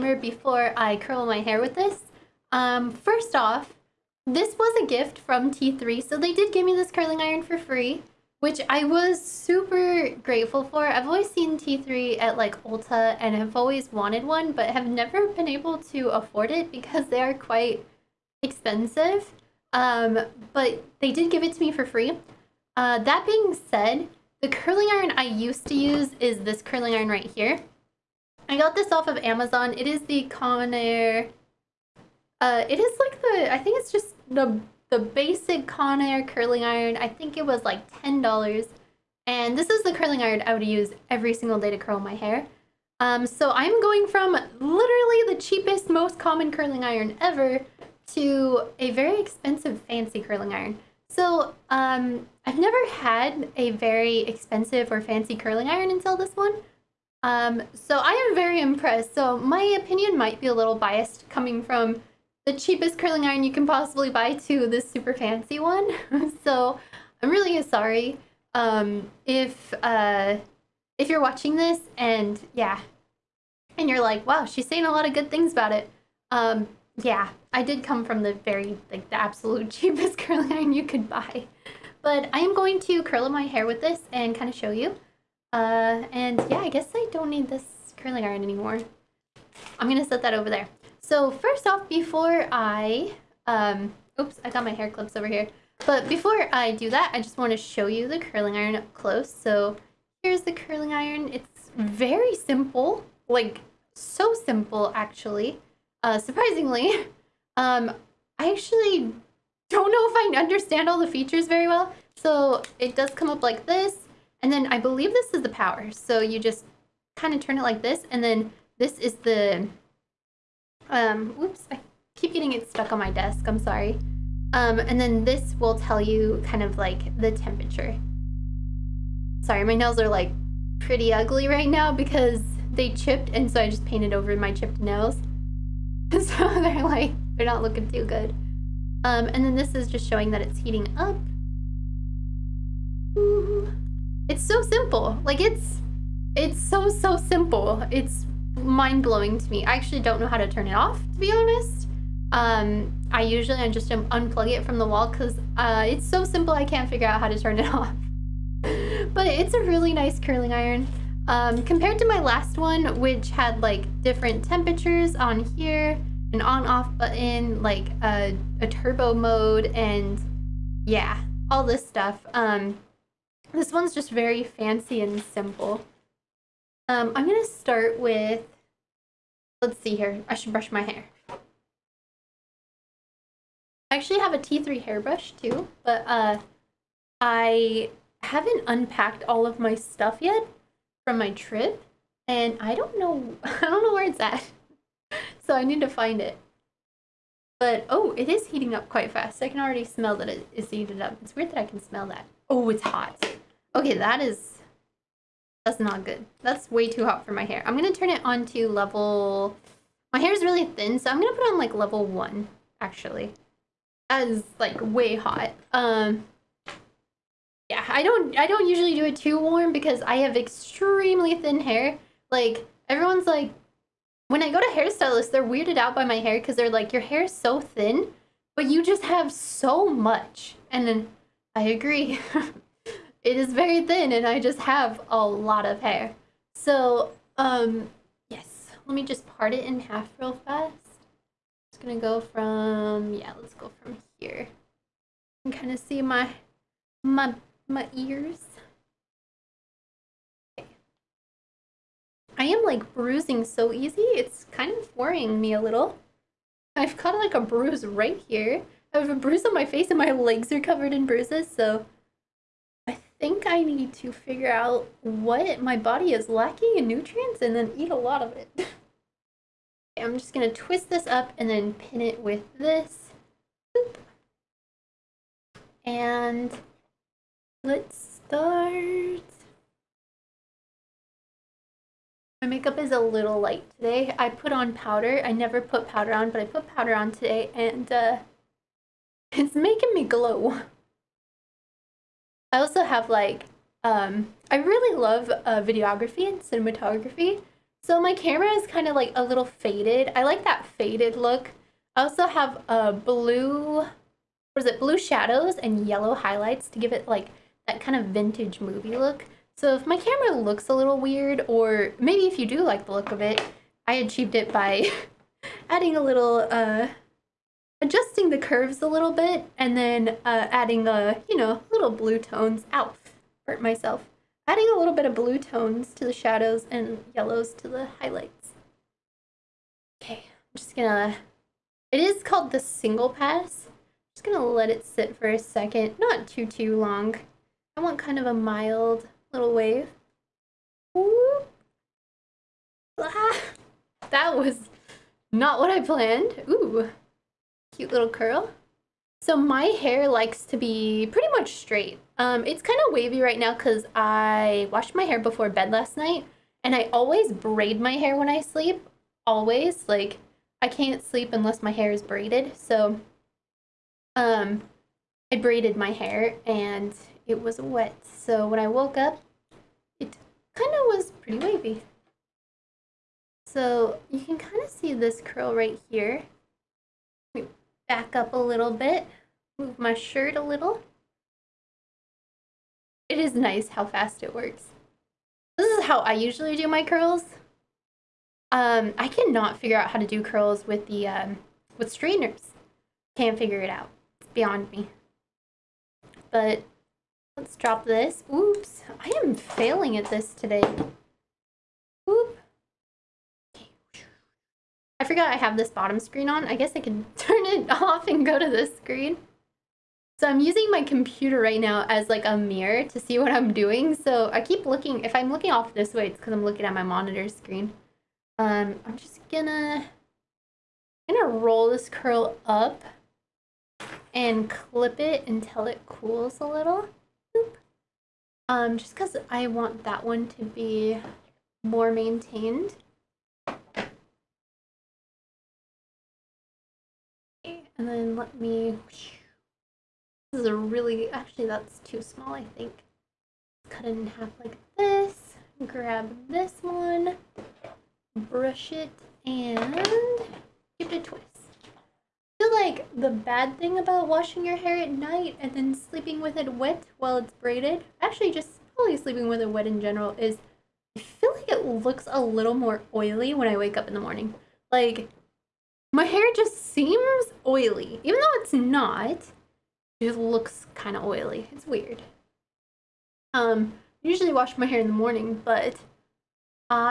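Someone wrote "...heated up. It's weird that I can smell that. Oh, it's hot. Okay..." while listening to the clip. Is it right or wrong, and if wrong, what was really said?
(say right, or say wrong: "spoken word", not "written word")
right.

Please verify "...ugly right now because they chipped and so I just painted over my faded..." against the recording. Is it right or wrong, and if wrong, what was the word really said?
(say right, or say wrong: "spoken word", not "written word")
wrong: "chipped", not "faded".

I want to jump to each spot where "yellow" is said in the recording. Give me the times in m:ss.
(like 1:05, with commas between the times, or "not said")
5:05, 5:27.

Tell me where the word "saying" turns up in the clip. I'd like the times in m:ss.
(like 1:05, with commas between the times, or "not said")
1:14.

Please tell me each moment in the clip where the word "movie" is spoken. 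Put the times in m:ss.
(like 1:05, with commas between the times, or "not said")
5:08.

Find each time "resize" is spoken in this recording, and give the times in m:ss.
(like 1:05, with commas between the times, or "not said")
not said.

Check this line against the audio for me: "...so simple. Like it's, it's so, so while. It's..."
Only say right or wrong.
wrong.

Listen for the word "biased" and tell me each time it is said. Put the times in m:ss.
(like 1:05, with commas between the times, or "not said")
1:00.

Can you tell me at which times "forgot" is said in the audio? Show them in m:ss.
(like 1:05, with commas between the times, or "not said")
6:45.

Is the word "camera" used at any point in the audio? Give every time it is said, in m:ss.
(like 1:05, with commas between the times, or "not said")
4:58, 5:09.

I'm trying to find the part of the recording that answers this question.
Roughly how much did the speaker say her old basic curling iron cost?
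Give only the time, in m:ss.
0:38.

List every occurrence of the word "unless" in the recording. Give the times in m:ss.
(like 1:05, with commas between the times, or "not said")
6:01.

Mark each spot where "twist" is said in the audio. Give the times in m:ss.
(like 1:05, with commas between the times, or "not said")
4:30, 7:31.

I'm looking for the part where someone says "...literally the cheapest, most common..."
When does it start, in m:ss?
0:44.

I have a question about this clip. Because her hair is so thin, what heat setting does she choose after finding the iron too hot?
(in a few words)
level 1.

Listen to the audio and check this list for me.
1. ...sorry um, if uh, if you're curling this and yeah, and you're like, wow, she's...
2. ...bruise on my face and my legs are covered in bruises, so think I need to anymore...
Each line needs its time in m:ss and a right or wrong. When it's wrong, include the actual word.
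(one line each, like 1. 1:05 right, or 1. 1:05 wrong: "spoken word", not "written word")
1. 1:07 wrong: "watching", not "curling"
2. 4:19 wrong: "figure", not "anymore".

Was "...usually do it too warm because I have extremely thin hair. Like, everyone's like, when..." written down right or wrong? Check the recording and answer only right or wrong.
right.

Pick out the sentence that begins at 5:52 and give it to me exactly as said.
Um, it's kind of wavy right now because I washed my hair before bed last night.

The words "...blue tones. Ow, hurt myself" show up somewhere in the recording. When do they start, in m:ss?
5:21.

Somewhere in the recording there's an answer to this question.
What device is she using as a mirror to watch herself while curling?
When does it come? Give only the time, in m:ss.
6:50.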